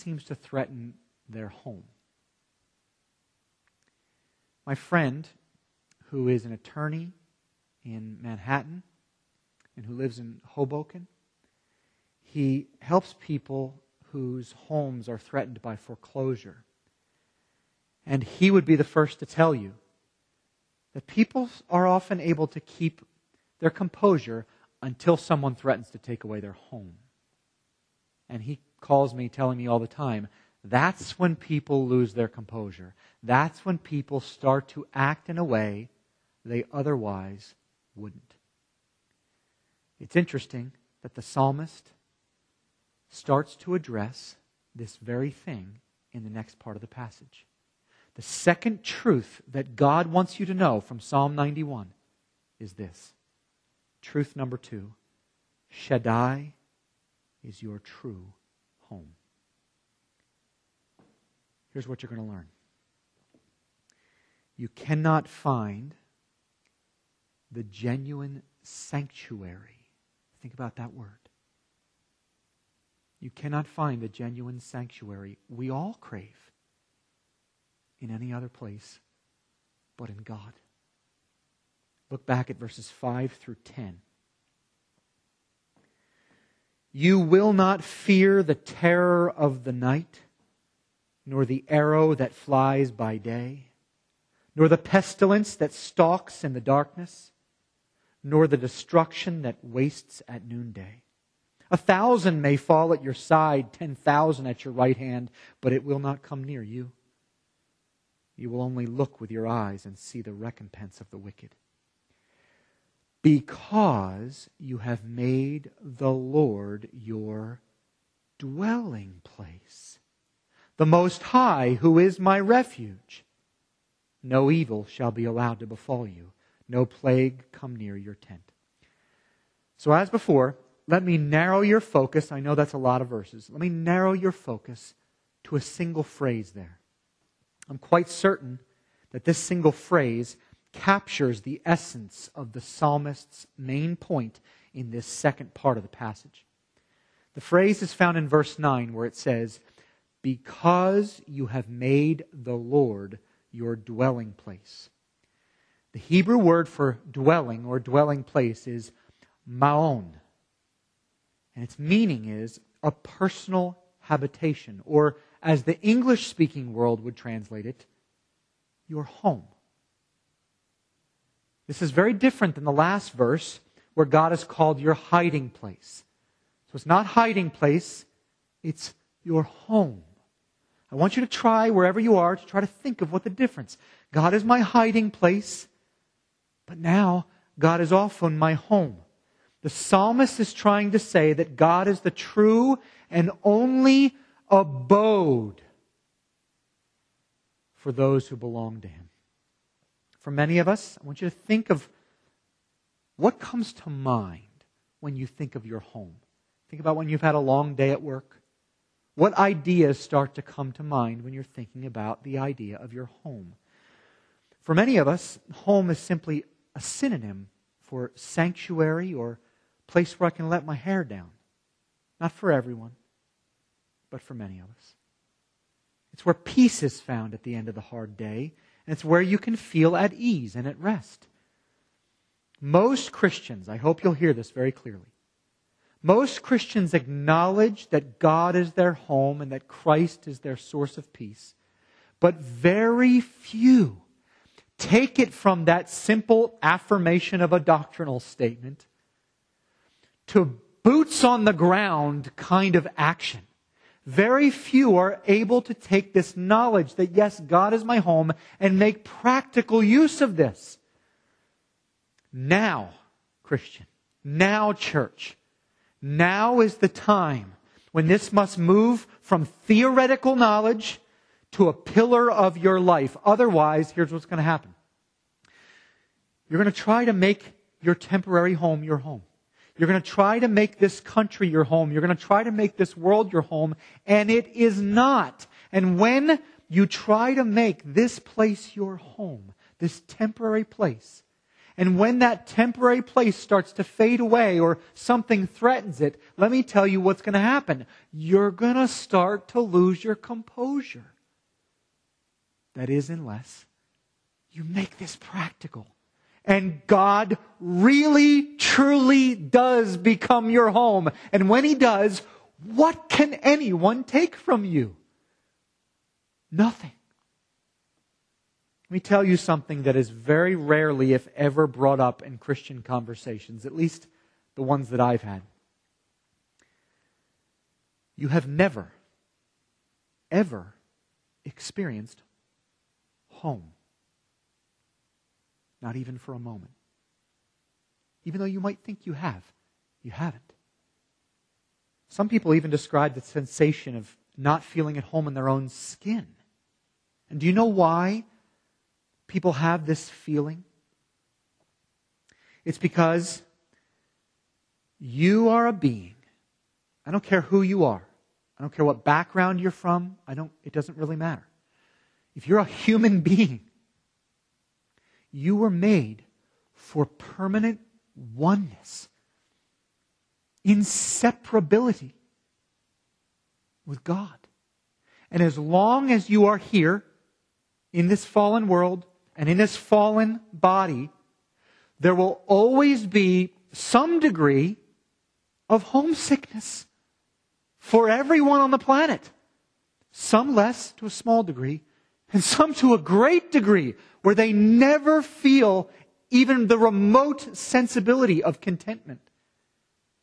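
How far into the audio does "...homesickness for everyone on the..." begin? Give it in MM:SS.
06:25.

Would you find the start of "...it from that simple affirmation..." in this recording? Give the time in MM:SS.
04:05.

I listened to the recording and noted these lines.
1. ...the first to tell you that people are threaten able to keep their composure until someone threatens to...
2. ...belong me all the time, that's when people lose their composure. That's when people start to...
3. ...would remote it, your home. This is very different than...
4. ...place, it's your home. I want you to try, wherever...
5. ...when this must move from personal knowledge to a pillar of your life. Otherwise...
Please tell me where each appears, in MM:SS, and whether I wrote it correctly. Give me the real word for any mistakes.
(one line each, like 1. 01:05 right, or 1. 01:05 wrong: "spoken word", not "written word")
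1. 00:18 wrong: "often", not "threaten"
2. 00:29 wrong: "telling", not "belong"
3. 02:47 wrong: "translate", not "remote"
4. 02:57 right
5. 04:27 wrong: "theoretical", not "personal".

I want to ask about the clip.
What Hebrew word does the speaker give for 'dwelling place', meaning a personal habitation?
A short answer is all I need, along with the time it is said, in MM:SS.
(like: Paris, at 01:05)
maon, at 02:39.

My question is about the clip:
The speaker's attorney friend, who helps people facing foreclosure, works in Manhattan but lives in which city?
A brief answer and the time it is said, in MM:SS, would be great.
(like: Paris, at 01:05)
Hoboken, at 00:10.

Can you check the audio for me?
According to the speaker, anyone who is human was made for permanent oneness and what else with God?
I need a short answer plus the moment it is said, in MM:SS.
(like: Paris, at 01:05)
inseparability, at 06:10.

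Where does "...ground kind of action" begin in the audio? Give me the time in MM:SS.
04:11.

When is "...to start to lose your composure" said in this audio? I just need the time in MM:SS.
04:58.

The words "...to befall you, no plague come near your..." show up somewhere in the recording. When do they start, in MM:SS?
02:05.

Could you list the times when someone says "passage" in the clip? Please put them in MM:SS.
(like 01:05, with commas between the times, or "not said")
00:46, 02:25.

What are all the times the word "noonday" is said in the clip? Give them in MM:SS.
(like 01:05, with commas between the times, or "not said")
01:40.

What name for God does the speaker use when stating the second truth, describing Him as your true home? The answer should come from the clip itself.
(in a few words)
Shaddai.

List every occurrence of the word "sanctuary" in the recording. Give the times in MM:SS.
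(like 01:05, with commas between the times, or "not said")
01:08, 01:14, 03:38.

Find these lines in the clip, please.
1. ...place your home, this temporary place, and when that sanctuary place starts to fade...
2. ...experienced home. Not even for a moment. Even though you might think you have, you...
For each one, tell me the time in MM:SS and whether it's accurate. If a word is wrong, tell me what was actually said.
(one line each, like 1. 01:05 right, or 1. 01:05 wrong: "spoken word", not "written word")
1. 04:48 wrong: "temporary", not "sanctuary"
2. 05:31 right.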